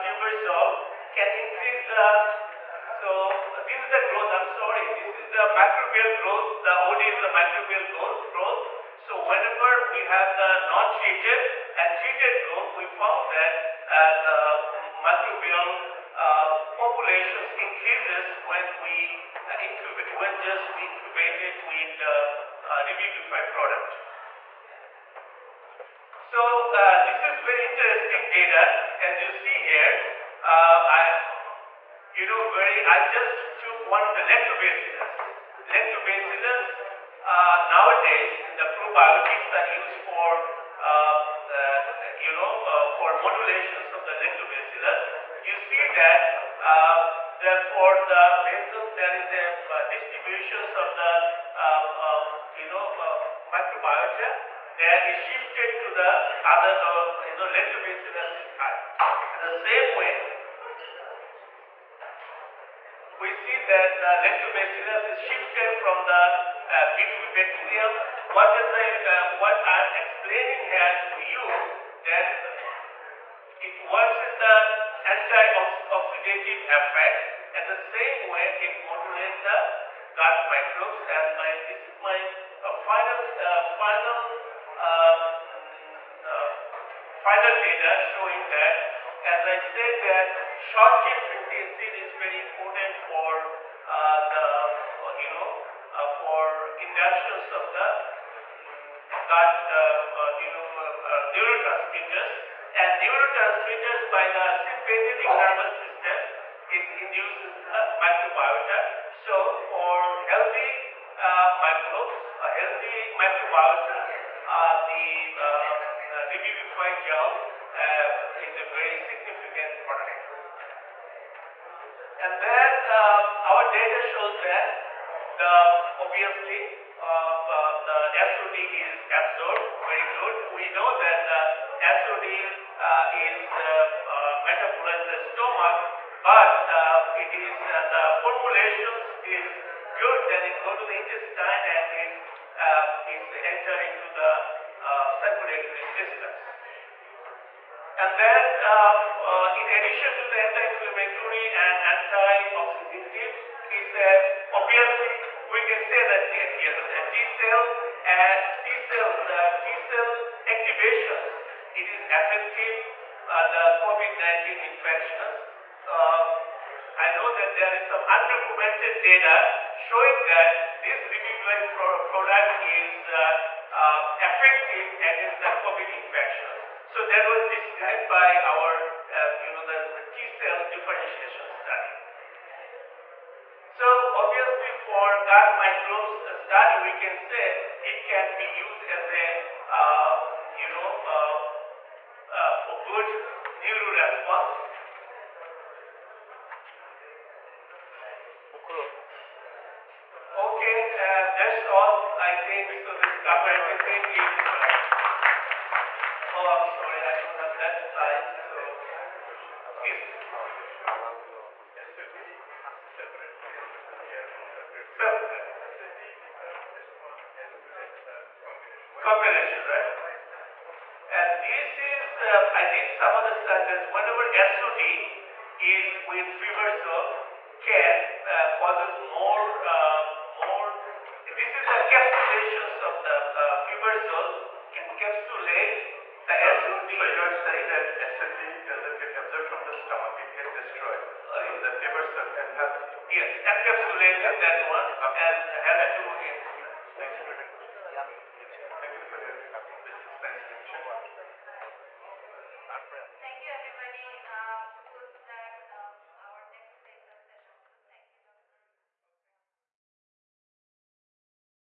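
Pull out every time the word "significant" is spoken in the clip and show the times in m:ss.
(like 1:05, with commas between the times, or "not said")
1:58.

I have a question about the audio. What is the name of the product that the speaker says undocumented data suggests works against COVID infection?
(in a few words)
Revivify.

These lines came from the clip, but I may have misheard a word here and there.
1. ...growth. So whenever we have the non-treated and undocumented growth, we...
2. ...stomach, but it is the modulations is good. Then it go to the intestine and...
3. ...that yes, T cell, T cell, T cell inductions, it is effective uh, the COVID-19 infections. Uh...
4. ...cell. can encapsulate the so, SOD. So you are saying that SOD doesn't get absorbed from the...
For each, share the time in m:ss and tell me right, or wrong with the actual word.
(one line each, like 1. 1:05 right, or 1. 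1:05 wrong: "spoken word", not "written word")
1. 0:08 wrong: "treated", not "undocumented"
2. 2:15 wrong: "formulations", not "modulations"
3. 2:36 wrong: "activations", not "inductions"
4. 3:54 right.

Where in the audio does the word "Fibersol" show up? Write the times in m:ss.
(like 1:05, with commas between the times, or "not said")
0:00, 3:46, 4:01.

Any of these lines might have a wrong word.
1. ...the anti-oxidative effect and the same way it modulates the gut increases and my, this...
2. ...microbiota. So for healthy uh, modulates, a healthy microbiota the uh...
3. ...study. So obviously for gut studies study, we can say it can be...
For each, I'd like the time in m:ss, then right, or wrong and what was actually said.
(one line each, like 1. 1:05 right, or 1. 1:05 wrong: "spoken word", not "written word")
1. 1:14 wrong: "microbes", not "increases"
2. 1:47 wrong: "microbes", not "modulates"
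3. 3:01 wrong: "microbes", not "studies".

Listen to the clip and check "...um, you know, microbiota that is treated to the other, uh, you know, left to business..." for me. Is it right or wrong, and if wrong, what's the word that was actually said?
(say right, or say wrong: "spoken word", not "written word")
wrong: "shifted", not "treated".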